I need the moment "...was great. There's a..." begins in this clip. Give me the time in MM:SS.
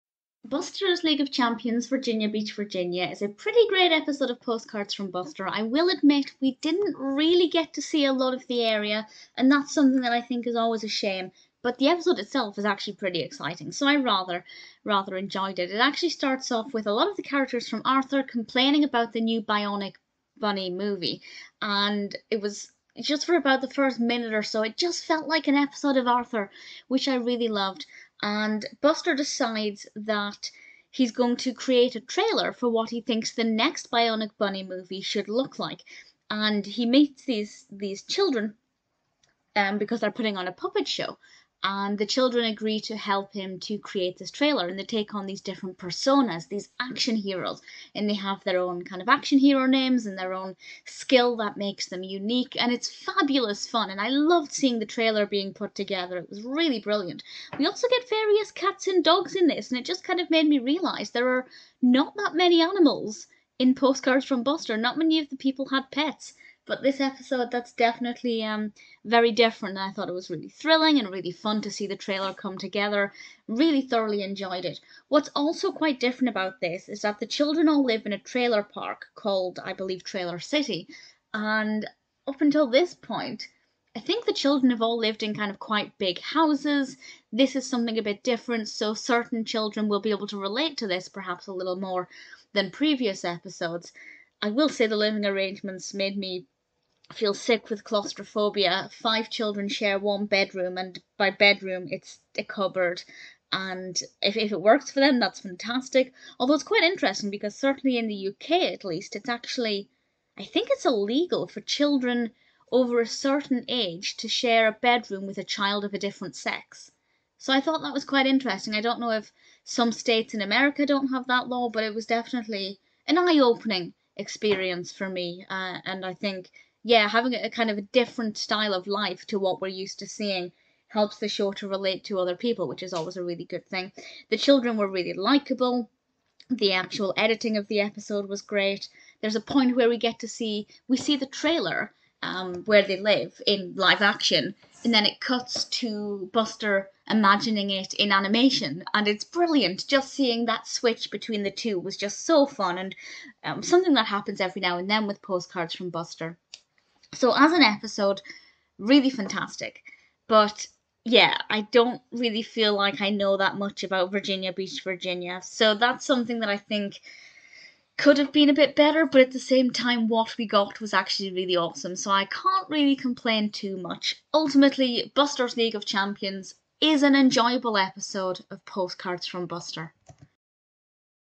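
02:18.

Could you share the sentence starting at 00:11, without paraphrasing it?
But the episode itself is actually pretty exciting, so I rather, rather enjoyed it.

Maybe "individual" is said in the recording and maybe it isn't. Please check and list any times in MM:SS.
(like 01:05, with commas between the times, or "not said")
not said.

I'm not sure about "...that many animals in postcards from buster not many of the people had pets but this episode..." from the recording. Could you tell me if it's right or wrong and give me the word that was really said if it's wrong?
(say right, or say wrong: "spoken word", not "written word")
right.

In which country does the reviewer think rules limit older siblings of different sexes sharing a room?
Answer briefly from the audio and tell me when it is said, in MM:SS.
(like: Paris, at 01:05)
UK, at 01:48.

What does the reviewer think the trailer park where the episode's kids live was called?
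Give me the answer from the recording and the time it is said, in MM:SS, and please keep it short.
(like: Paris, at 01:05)
Trailer City, at 01:20.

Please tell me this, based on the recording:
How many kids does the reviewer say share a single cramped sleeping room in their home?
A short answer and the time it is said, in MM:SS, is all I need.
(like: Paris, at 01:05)
5, at 01:38.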